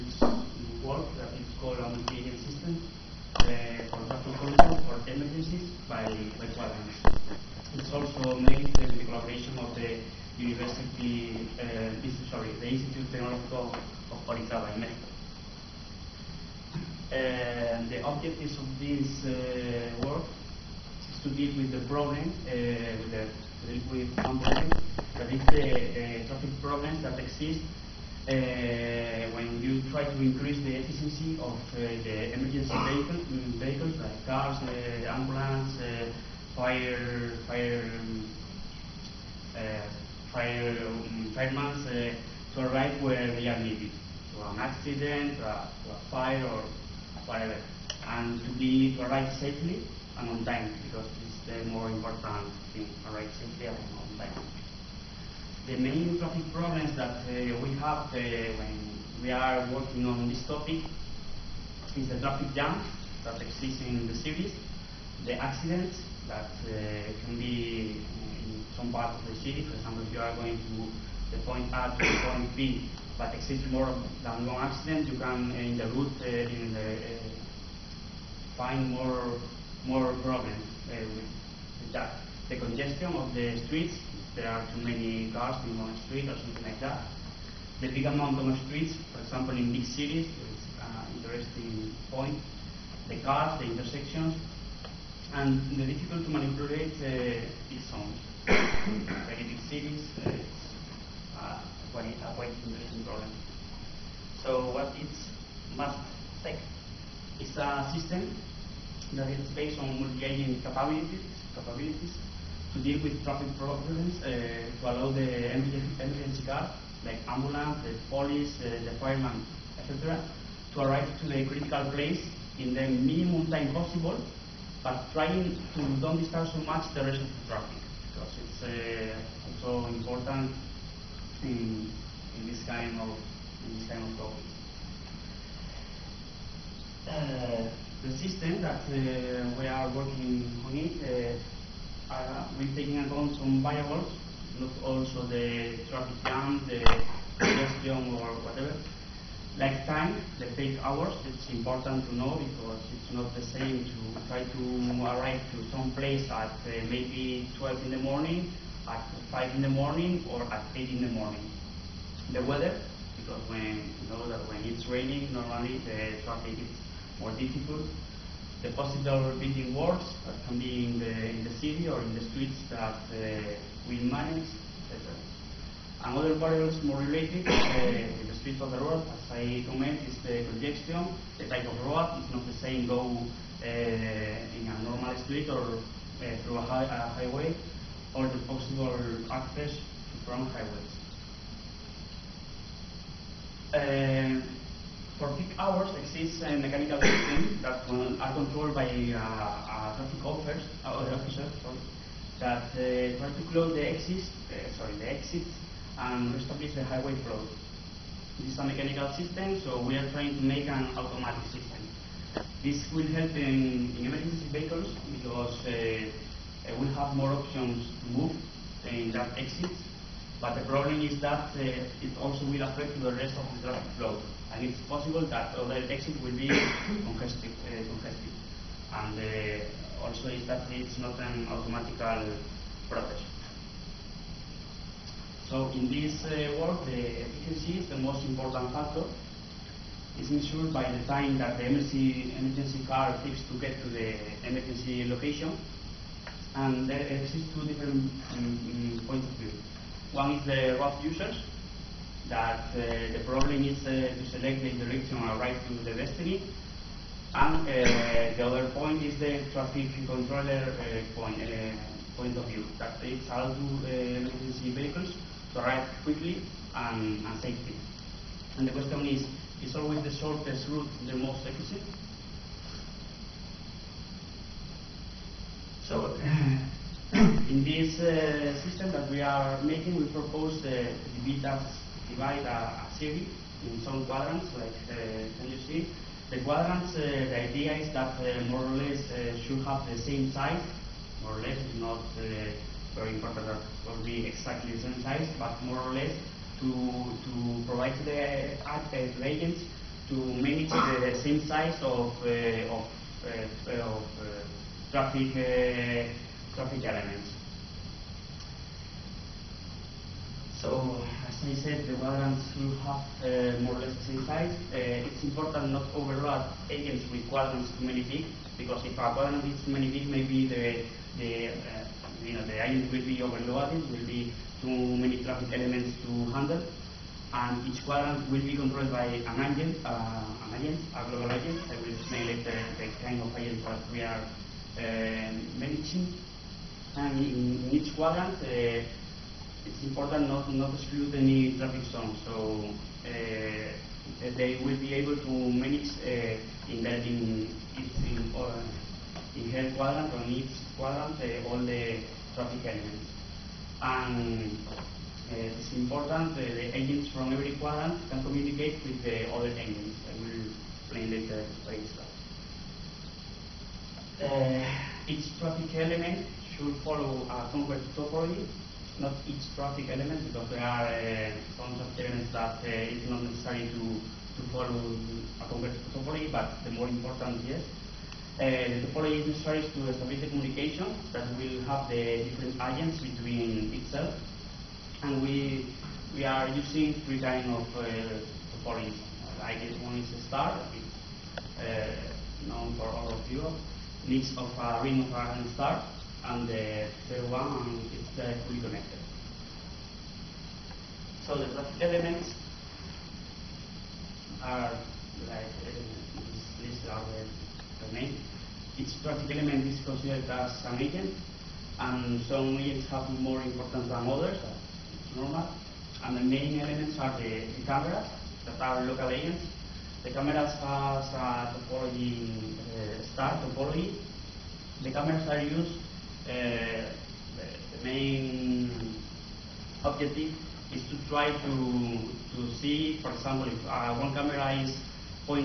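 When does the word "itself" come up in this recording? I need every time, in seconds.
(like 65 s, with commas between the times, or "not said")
361 s, 383 s.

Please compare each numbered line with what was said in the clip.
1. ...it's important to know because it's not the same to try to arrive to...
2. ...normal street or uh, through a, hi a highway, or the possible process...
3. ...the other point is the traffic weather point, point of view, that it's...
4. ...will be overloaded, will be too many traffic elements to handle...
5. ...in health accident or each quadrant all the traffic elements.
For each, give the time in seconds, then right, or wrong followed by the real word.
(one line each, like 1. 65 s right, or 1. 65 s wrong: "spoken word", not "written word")
1. 151 s right
2. 184 s wrong: "access", not "process"
3. 258 s wrong: "controller", not "weather"
4. 322 s right
5. 349 s wrong: "quadrant", not "accident".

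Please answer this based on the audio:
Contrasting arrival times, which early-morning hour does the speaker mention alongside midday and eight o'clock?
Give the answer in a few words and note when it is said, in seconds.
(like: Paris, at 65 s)
5 in the morning, at 158 s.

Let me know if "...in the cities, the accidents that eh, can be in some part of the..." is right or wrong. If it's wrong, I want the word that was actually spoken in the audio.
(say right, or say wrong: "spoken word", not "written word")
right.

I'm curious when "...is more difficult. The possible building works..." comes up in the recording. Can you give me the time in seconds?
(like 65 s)
166 s.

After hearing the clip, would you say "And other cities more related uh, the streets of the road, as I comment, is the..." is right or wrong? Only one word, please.
wrong.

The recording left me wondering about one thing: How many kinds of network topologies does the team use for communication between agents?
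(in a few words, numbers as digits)
3.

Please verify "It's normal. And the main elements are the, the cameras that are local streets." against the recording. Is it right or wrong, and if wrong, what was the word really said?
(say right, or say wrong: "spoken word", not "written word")
wrong: "agents", not "streets".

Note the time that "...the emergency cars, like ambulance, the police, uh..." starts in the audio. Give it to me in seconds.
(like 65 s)
115 s.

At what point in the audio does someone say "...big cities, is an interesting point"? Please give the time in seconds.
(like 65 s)
89 s.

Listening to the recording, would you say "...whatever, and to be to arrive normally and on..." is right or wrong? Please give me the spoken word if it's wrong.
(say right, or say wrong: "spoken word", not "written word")
wrong: "safely", not "normally".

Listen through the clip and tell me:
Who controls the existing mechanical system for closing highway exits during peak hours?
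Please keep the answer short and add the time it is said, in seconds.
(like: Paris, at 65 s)
Traffic officers, at 199 s.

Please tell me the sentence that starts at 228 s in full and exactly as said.
And uh, also is that it's not an automatical process.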